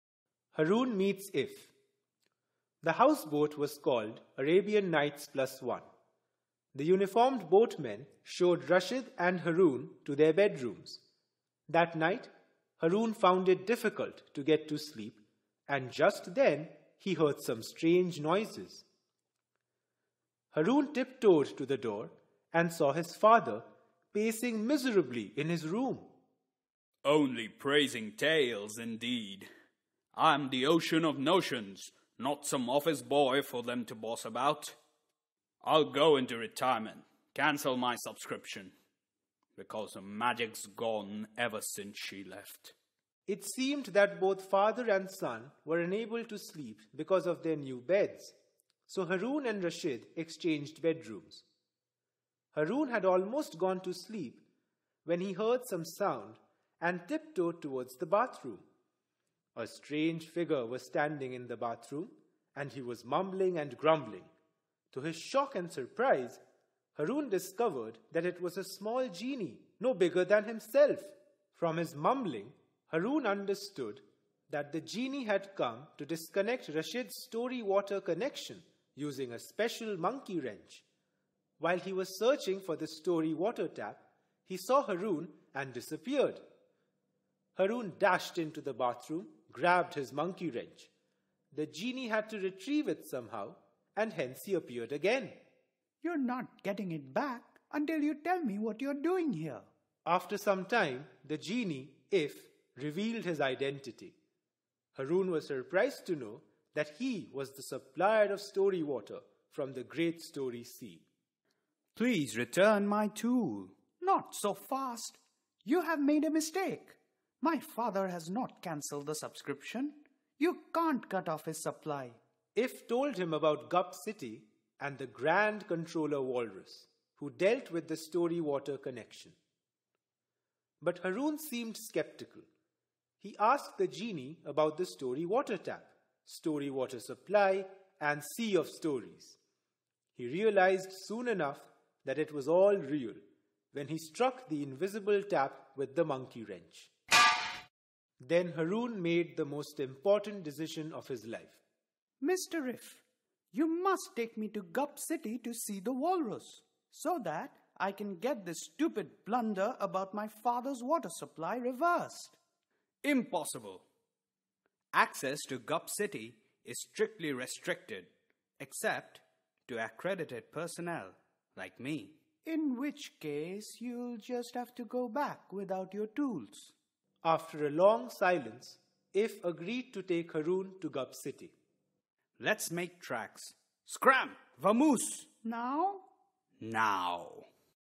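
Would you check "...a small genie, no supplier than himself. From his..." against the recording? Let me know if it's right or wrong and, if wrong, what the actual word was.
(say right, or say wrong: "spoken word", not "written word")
wrong: "bigger", not "supplier".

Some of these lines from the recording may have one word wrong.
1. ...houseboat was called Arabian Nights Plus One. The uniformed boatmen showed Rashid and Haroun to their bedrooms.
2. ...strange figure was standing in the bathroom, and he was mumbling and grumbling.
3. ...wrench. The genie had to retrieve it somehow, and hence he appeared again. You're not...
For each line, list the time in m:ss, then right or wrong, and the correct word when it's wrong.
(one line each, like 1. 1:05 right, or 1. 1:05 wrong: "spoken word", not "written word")
1. 0:02 right
2. 0:59 right
3. 1:30 right.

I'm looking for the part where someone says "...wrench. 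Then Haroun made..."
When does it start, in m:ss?
2:26.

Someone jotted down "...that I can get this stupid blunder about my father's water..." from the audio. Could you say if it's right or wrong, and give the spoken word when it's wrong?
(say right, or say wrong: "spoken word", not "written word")
right.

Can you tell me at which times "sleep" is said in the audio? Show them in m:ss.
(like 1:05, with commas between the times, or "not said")
0:14, 0:46, 0:53.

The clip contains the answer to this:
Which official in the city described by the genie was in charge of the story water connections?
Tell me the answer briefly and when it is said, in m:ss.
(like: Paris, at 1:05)
Grand Controller Walrus, at 2:05.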